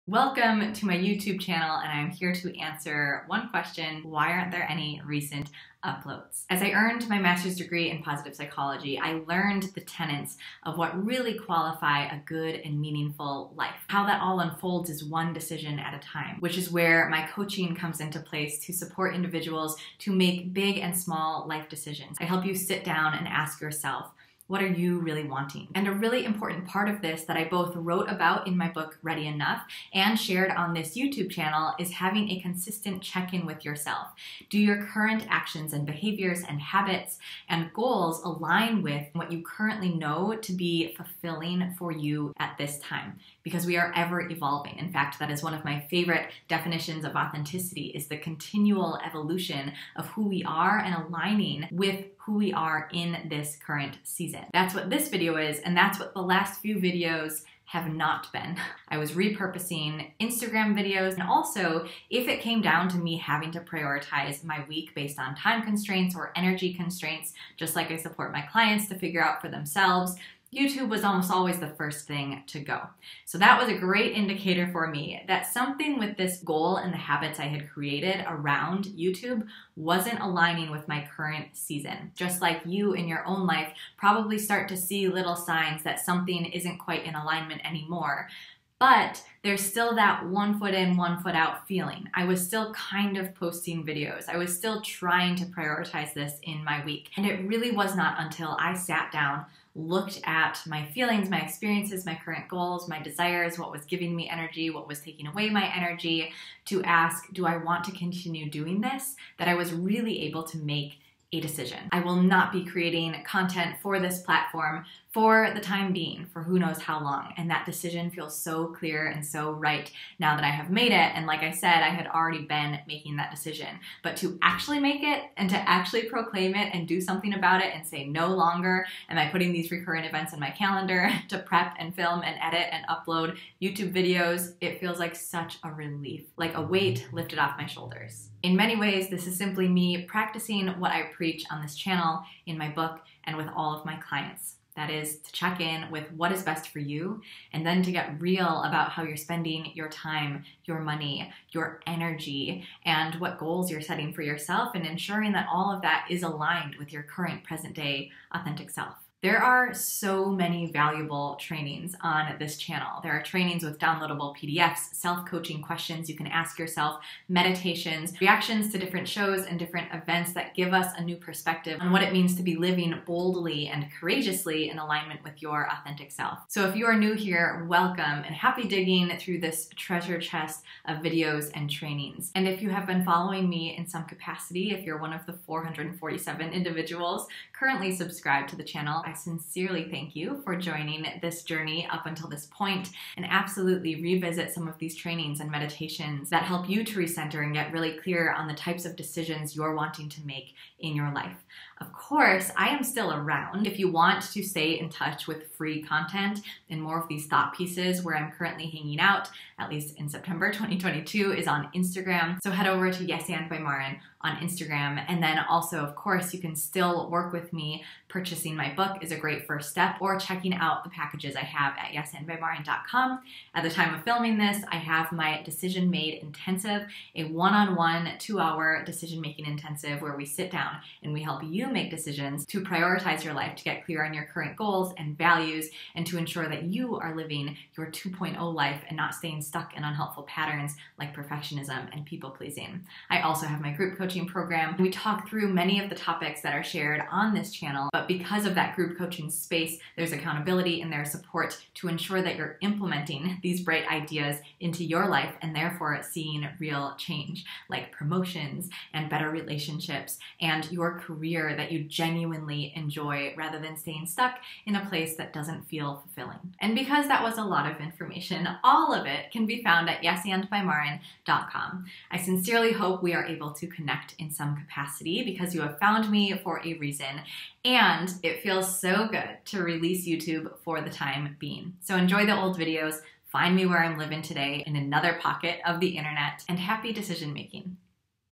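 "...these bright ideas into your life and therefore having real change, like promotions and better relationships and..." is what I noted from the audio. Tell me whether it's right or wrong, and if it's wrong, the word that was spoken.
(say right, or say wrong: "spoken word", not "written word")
wrong: "seeing", not "having".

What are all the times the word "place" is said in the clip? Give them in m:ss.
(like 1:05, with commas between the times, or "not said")
0:18, 4:24.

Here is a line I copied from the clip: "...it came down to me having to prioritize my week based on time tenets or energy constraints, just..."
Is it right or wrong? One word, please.
wrong.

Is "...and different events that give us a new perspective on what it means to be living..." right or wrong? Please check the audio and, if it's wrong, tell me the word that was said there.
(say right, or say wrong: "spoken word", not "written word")
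right.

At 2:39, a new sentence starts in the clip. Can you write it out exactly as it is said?
There are so many valuable trainings on this channel.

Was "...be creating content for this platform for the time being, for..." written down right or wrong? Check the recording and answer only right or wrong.
right.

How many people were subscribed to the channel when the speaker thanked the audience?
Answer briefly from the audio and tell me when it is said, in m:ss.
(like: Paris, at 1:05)
447, at 3:05.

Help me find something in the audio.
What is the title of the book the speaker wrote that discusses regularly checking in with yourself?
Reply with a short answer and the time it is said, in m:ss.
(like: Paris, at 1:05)
Ready Enough, at 0:29.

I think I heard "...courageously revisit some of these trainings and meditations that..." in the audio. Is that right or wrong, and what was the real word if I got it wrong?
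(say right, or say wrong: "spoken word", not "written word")
wrong: "absolutely", not "courageously".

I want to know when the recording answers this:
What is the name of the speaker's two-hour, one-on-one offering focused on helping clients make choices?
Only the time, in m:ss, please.
3:45.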